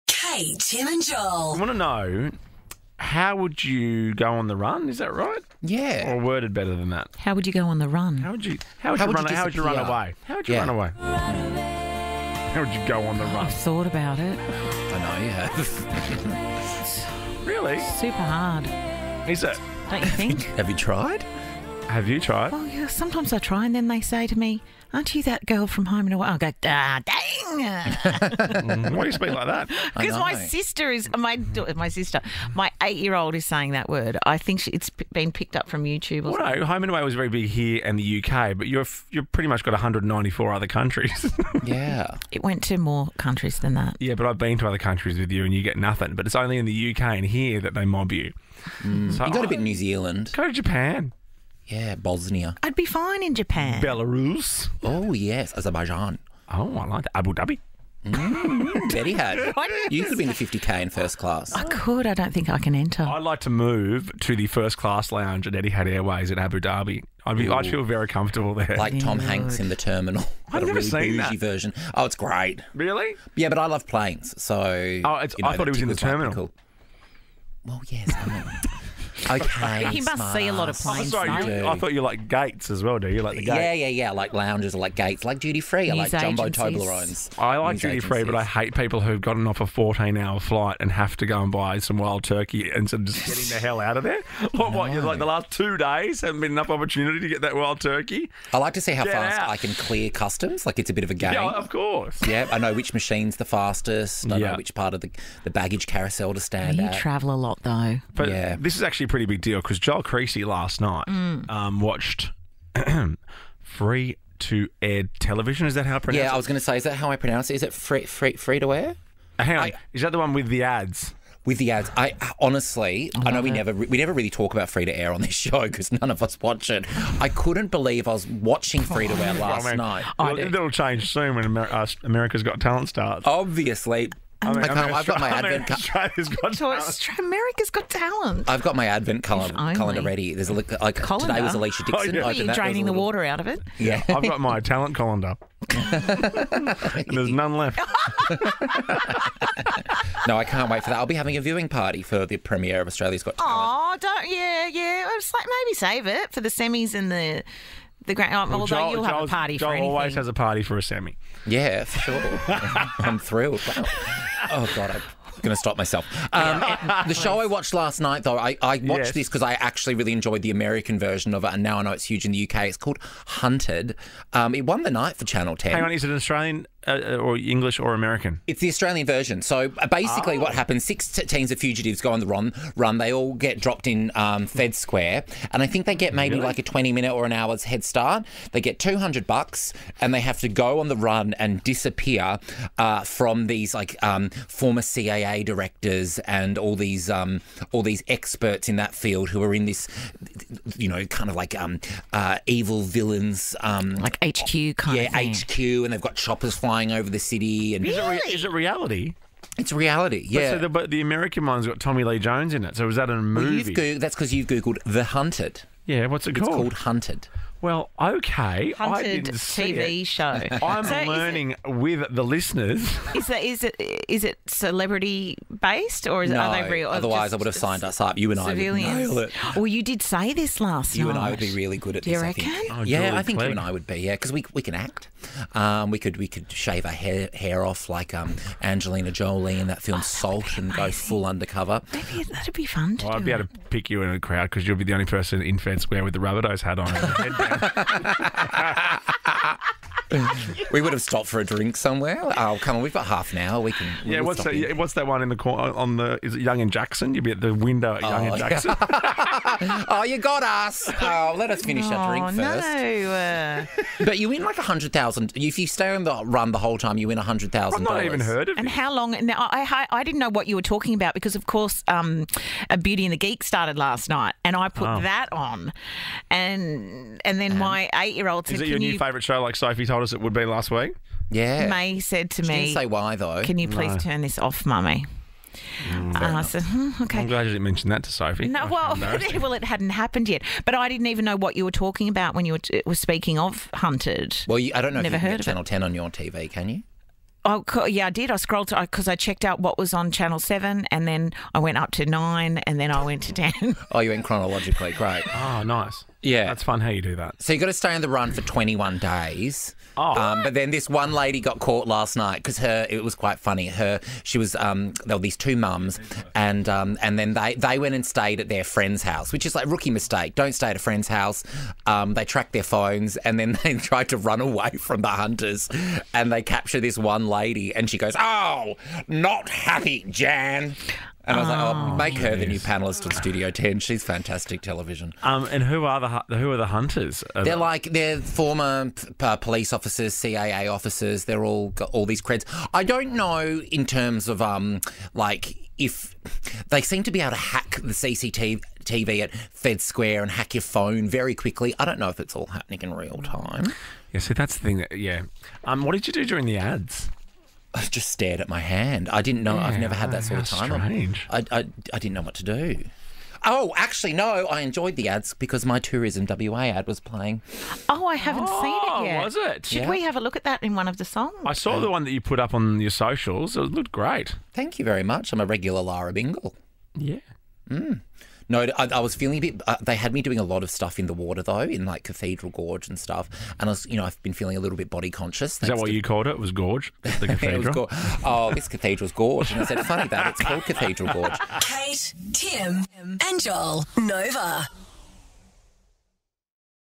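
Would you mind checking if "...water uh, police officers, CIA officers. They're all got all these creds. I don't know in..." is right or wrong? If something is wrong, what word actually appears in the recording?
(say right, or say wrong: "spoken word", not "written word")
wrong: "former", not "water".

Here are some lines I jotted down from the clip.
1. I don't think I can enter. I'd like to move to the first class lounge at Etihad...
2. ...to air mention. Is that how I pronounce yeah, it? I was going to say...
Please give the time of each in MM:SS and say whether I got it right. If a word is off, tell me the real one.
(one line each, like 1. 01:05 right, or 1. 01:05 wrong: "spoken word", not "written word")
1. 01:02 right
2. 01:54 wrong: "television", not "mention".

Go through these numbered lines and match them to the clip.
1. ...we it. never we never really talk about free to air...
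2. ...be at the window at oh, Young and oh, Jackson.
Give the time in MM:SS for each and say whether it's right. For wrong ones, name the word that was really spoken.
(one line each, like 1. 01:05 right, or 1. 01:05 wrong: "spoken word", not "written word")
1. 02:03 right
2. 04:17 right.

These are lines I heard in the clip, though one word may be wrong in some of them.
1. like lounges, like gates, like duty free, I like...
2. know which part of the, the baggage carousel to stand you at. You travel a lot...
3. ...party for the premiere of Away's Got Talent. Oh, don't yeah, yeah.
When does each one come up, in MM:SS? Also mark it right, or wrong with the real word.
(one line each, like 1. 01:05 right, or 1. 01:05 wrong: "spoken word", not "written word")
1. 01:24 right
2. 01:44 right
3. 02:31 wrong: "Australia", not "Away".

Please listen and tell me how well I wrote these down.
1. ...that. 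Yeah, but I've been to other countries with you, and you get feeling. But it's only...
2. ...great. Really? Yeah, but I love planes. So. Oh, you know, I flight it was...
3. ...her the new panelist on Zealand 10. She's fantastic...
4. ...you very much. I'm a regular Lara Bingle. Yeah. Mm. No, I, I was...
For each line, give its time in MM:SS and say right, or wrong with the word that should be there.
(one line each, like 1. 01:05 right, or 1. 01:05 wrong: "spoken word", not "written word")
1. 00:43 wrong: "nothing", not "feeling"
2. 01:12 wrong: "thought", not "flight"
3. 05:32 wrong: "Studio", not "Zealand"
4. 06:14 right.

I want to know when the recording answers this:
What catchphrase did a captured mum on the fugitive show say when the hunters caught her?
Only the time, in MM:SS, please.
05:29.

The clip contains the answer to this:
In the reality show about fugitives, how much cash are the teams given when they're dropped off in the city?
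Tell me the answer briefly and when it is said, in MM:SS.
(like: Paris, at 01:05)
$200, at 03:08.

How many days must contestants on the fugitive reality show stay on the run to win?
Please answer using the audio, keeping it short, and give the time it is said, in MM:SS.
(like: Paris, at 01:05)
21, at 05:08.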